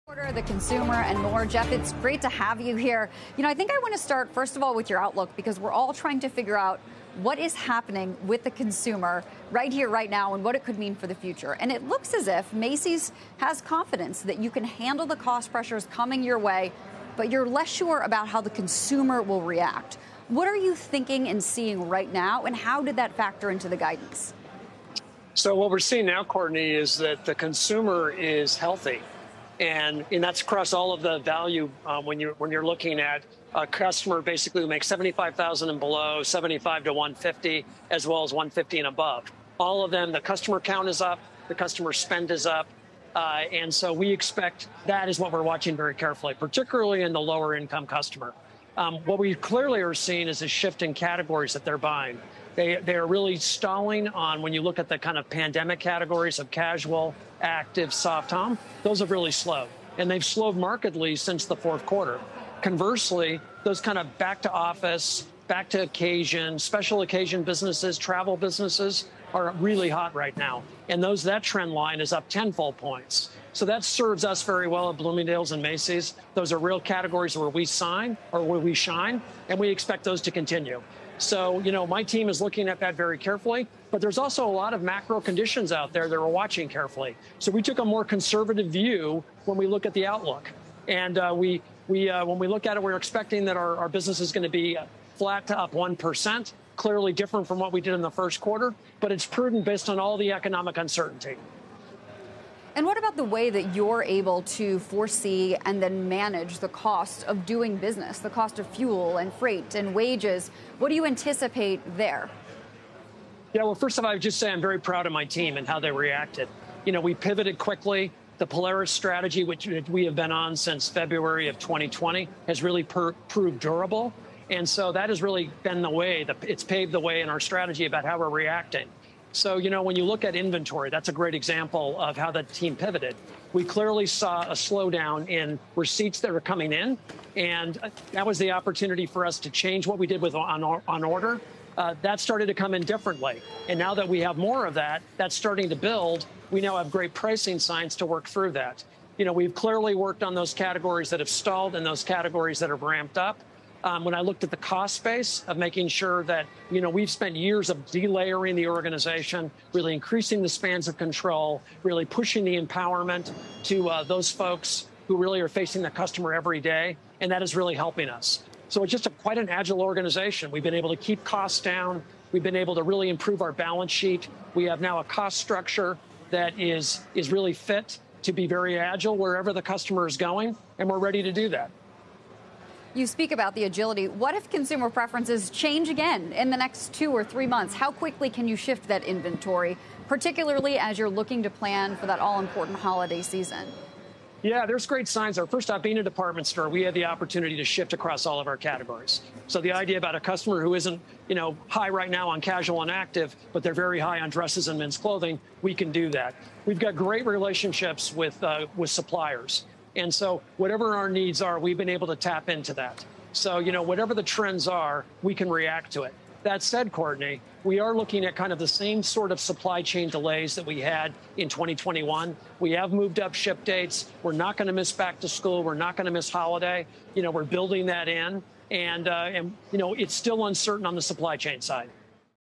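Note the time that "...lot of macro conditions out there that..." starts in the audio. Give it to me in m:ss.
1:24.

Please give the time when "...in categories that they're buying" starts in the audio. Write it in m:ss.
0:50.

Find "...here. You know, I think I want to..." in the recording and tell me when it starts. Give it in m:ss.
0:02.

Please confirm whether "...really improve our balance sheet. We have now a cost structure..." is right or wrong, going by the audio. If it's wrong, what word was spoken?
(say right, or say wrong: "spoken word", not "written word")
right.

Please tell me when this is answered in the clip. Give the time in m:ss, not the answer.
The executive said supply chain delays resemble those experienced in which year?
3:41.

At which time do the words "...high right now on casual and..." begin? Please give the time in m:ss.
3:21.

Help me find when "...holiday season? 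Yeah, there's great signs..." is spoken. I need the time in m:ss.
3:12.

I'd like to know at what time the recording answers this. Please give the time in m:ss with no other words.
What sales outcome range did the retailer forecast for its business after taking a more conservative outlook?
1:35.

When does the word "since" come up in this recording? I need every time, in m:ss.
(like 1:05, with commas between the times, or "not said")
1:01, 2:00.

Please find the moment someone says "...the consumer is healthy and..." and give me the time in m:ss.
0:27.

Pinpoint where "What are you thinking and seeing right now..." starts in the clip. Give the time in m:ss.
0:20.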